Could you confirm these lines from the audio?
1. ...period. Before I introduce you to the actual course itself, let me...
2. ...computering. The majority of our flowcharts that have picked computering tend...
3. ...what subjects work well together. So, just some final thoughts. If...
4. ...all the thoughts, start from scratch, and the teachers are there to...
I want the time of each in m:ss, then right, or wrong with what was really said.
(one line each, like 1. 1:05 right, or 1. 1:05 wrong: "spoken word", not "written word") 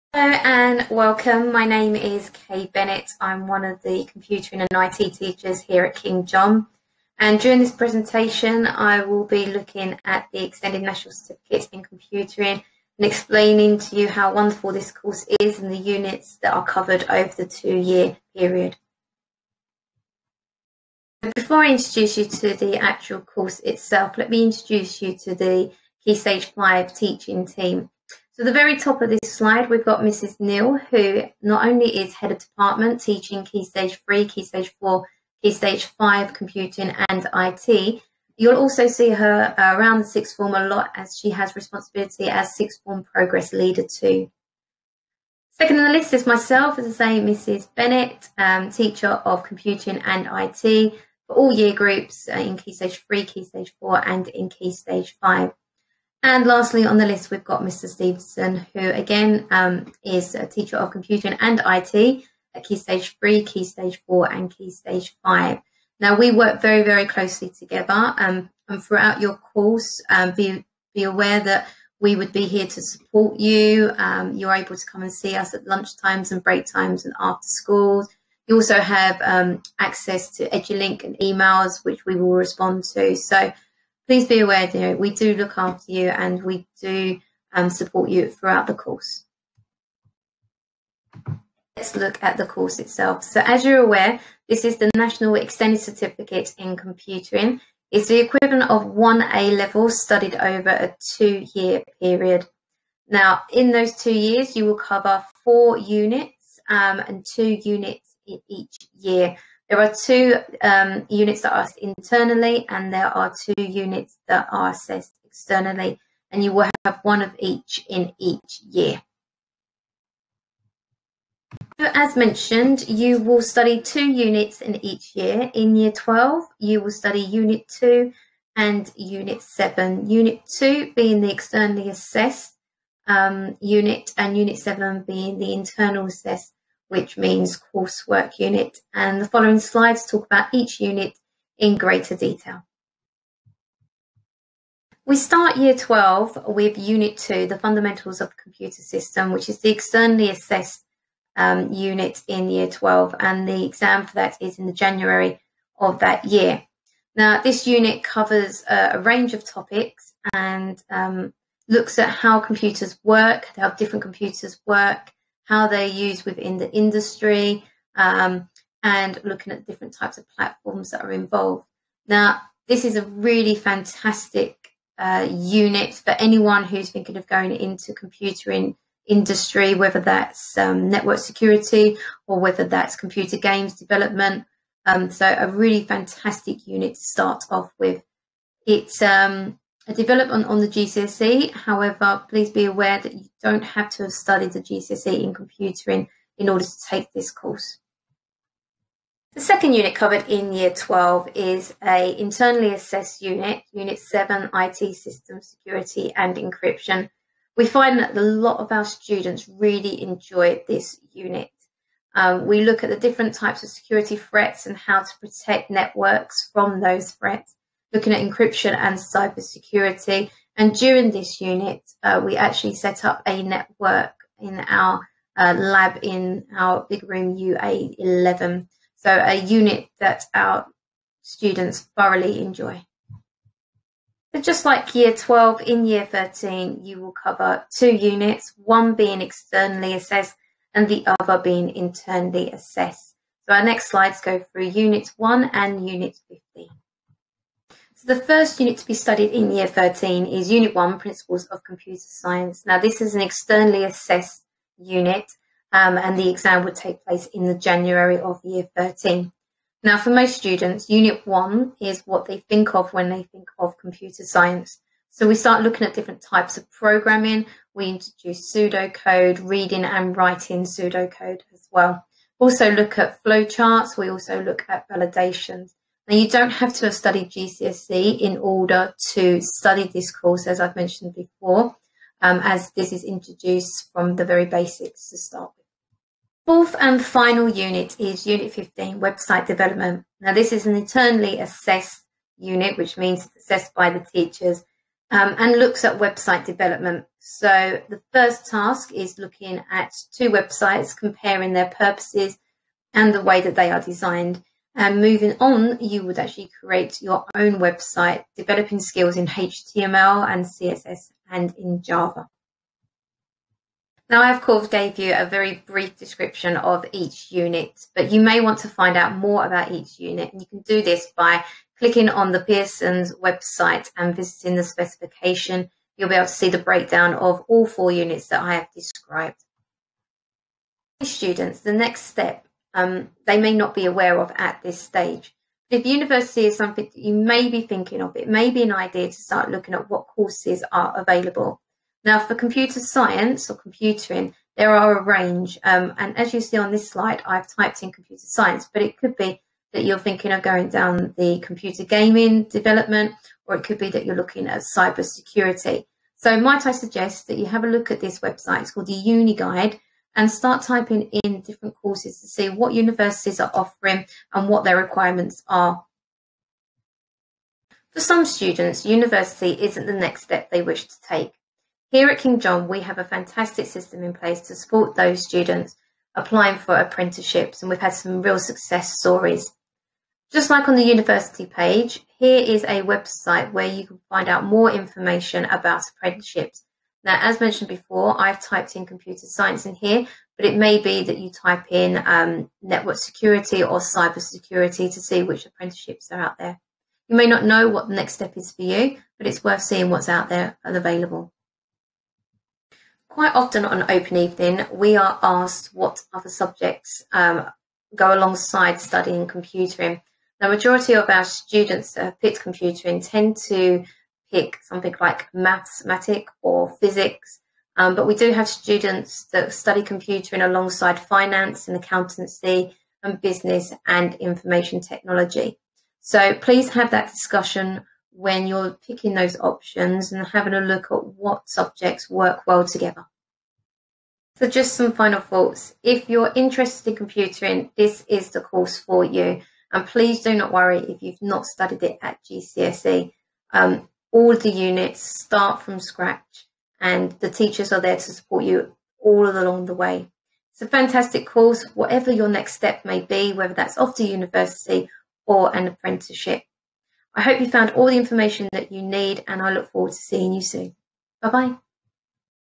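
1. 0:18 right
2. 6:49 wrong: "students", not "flowcharts"
3. 7:11 right
4. 7:24 wrong: "units", not "thoughts".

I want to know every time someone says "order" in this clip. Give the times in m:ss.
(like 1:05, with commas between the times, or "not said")
3:16, 4:38.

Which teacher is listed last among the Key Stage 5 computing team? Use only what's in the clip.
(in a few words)
Mr. Stevenson.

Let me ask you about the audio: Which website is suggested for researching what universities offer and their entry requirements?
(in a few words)
The Uni Guide.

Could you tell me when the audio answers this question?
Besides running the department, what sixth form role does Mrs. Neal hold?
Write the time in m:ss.
0:42.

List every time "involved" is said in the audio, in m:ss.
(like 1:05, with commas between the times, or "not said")
2:51.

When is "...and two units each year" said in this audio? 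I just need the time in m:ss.
1:46.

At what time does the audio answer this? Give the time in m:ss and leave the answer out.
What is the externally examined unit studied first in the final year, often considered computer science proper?
4:10.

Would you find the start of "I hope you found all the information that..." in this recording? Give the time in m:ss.
7:37.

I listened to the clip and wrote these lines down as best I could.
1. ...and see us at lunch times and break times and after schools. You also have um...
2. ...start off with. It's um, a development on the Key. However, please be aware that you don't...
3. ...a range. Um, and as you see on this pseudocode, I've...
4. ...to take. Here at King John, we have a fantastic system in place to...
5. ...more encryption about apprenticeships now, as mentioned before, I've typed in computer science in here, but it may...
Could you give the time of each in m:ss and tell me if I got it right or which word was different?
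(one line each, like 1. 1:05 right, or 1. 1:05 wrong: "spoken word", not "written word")
1. 1:15 right
2. 3:07 wrong: "GCSE", not "Key"
3. 5:44 wrong: "slide", not "pseudocode"
4. 6:10 right
5. 6:24 wrong: "information", not "encryption".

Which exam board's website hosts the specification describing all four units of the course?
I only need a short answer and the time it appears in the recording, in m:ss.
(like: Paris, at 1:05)
Pearson, at 5:22.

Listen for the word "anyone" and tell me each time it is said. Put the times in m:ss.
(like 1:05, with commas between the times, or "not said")
2:56.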